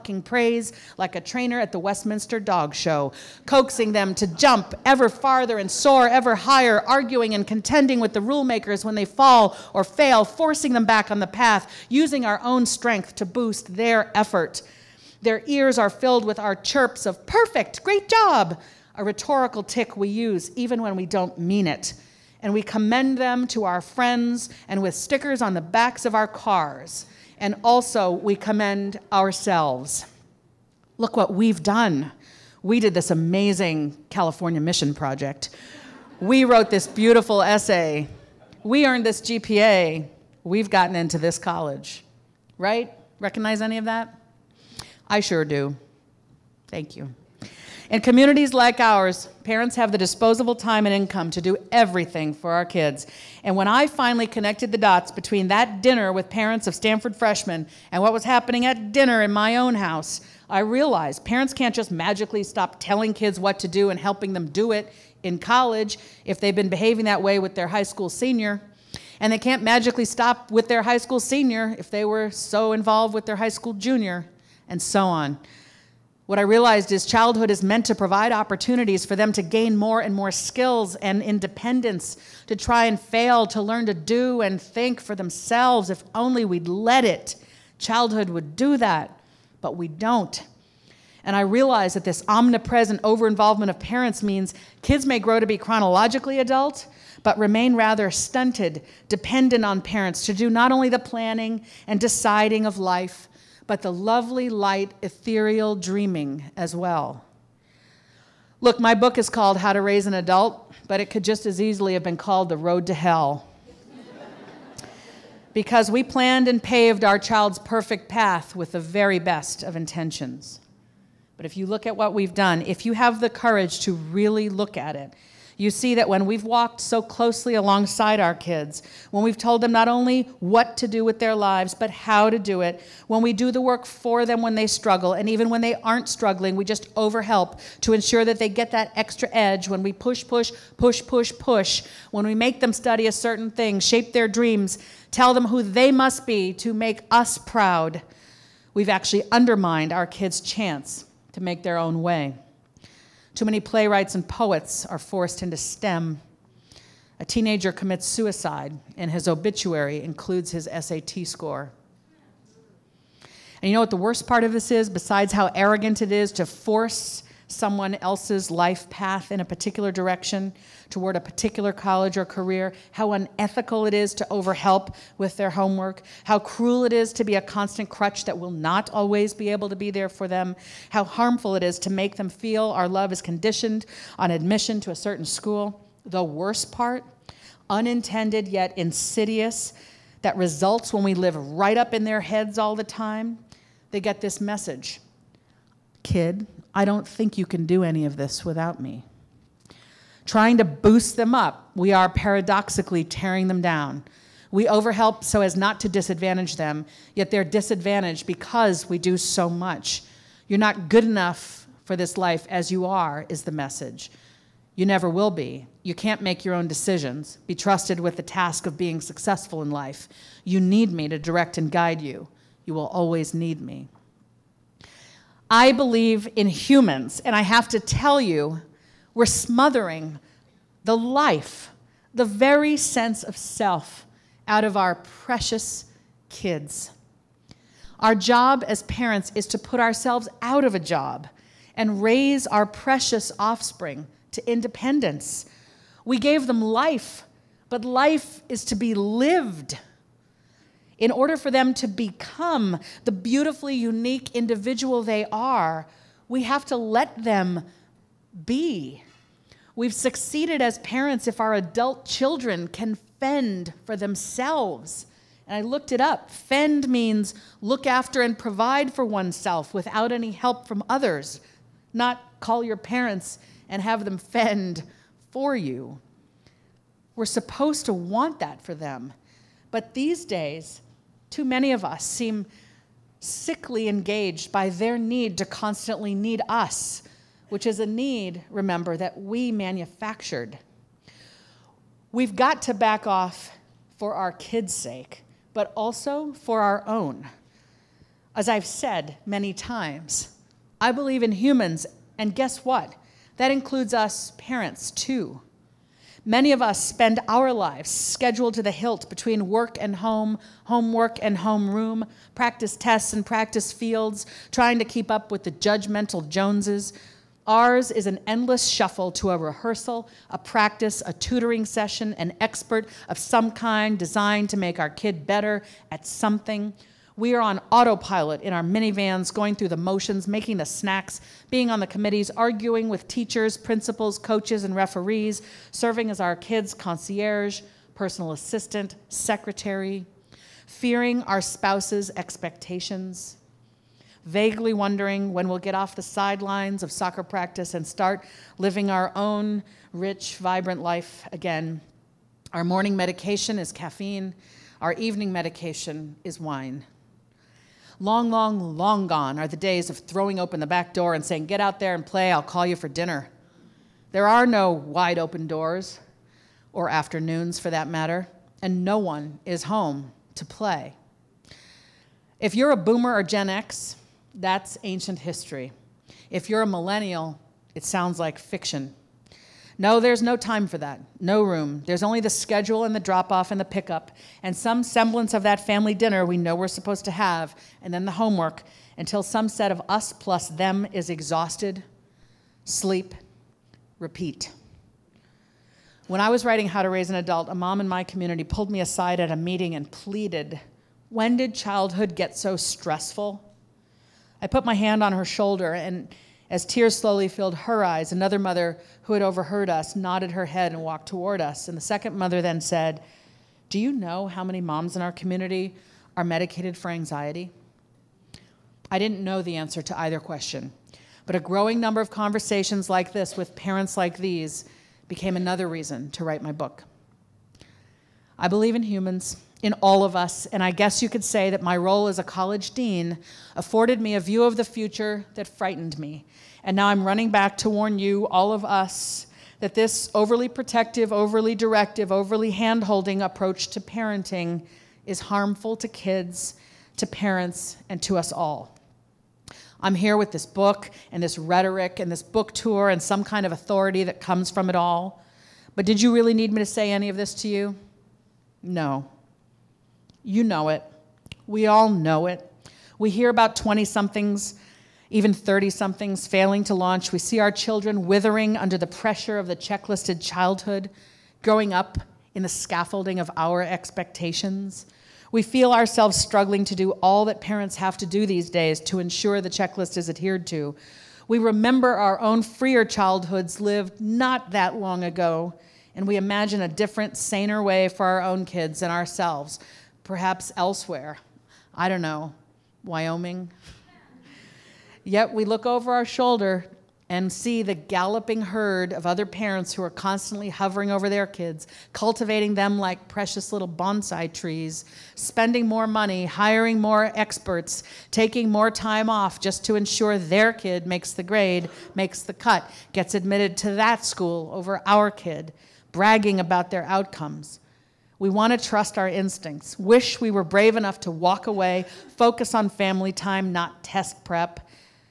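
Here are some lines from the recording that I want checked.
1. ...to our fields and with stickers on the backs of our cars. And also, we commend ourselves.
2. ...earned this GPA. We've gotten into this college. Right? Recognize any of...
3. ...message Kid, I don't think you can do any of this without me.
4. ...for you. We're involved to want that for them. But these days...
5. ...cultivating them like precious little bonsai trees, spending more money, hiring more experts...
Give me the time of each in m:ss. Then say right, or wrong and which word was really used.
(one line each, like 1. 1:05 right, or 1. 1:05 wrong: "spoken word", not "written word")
1. 0:23 wrong: "friends", not "fields"
2. 0:38 right
3. 3:14 right
4. 4:35 wrong: "supposed", not "involved"
5. 8:21 right.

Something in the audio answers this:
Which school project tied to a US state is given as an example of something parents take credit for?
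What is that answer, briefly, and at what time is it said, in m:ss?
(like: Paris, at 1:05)
California Mission Project, at 0:34.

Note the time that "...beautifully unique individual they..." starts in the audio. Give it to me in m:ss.
4:13.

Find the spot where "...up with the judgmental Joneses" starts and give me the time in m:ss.
5:15.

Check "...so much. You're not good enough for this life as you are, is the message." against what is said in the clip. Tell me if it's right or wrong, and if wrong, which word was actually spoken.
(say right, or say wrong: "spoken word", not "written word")
right.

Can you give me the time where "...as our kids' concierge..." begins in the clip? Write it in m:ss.
5:36.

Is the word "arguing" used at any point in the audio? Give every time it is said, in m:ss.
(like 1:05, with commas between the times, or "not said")
0:06, 5:32.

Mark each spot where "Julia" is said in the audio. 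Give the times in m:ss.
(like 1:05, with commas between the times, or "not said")
not said.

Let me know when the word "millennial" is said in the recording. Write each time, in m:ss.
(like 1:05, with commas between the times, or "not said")
6:16.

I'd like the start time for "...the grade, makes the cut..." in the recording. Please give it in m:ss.
8:31.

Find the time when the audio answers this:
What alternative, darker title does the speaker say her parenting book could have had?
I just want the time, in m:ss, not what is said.
1:52.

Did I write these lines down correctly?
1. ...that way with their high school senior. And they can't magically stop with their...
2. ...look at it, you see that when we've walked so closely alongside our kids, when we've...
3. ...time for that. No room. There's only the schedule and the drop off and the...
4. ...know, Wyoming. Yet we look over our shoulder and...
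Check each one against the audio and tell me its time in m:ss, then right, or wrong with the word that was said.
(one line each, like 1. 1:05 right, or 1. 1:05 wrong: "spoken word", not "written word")
1. 1:07 right
2. 2:04 right
3. 6:20 right
4. 8:12 right.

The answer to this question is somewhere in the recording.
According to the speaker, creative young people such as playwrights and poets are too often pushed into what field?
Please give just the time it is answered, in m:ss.
2:35.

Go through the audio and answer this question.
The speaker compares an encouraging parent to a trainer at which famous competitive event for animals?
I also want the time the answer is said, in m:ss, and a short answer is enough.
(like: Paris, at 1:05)
Westminster Dog Show, at 0:01.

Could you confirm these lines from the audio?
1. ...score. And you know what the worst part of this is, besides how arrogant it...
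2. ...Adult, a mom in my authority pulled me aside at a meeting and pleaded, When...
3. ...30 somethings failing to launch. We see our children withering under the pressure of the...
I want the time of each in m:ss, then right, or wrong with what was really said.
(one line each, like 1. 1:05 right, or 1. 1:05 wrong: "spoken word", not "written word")
1. 2:41 right
2. 6:37 wrong: "community", not "authority"
3. 7:45 right.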